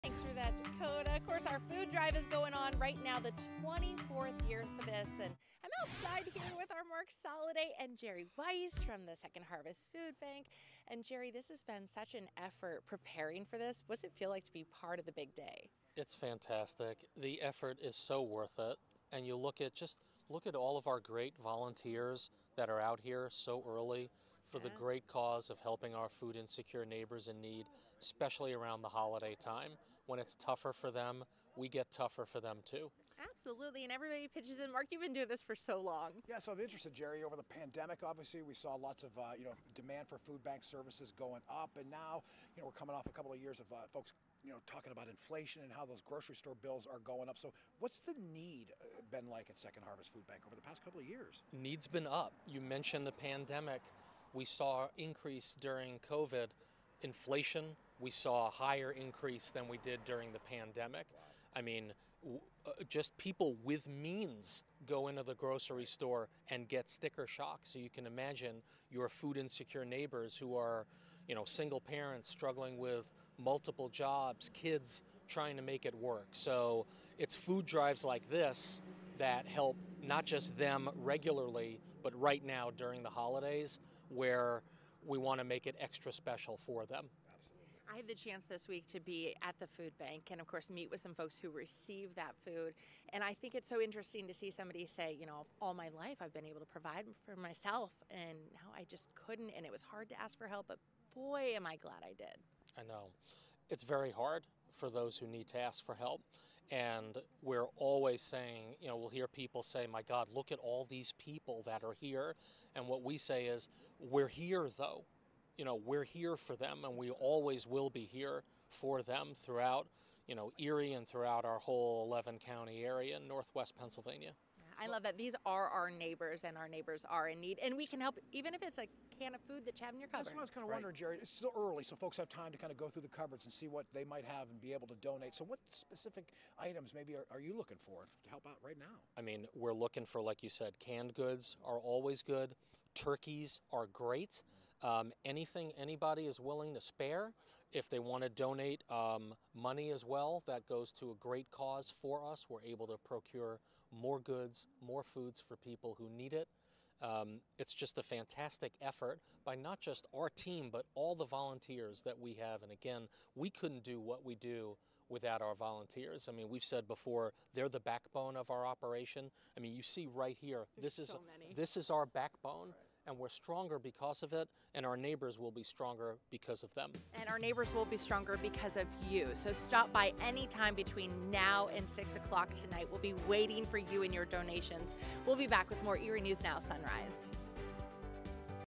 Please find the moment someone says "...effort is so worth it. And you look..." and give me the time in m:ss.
0:17.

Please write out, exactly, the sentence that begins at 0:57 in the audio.
We saw a higher increase than we did during the pandemic.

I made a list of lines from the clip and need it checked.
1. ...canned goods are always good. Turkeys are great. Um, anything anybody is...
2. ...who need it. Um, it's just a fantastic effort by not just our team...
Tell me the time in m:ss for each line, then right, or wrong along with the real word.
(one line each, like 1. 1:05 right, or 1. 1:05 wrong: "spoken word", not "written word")
1. 2:20 right
2. 2:35 right.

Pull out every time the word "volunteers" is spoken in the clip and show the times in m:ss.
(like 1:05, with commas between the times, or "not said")
0:21, 2:41, 2:45.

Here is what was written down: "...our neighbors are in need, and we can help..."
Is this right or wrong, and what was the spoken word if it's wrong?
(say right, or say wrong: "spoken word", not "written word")
right.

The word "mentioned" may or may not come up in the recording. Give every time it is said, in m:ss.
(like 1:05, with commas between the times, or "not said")
0:52.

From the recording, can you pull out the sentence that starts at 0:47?
So, what's the need uh, been like at Second Harvest Food Bank over the past couple of years?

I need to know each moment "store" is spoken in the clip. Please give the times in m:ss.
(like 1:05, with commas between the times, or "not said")
0:46, 1:05.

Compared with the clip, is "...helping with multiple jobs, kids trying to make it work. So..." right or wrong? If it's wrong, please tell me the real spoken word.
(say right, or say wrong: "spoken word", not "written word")
wrong: "struggling", not "helping".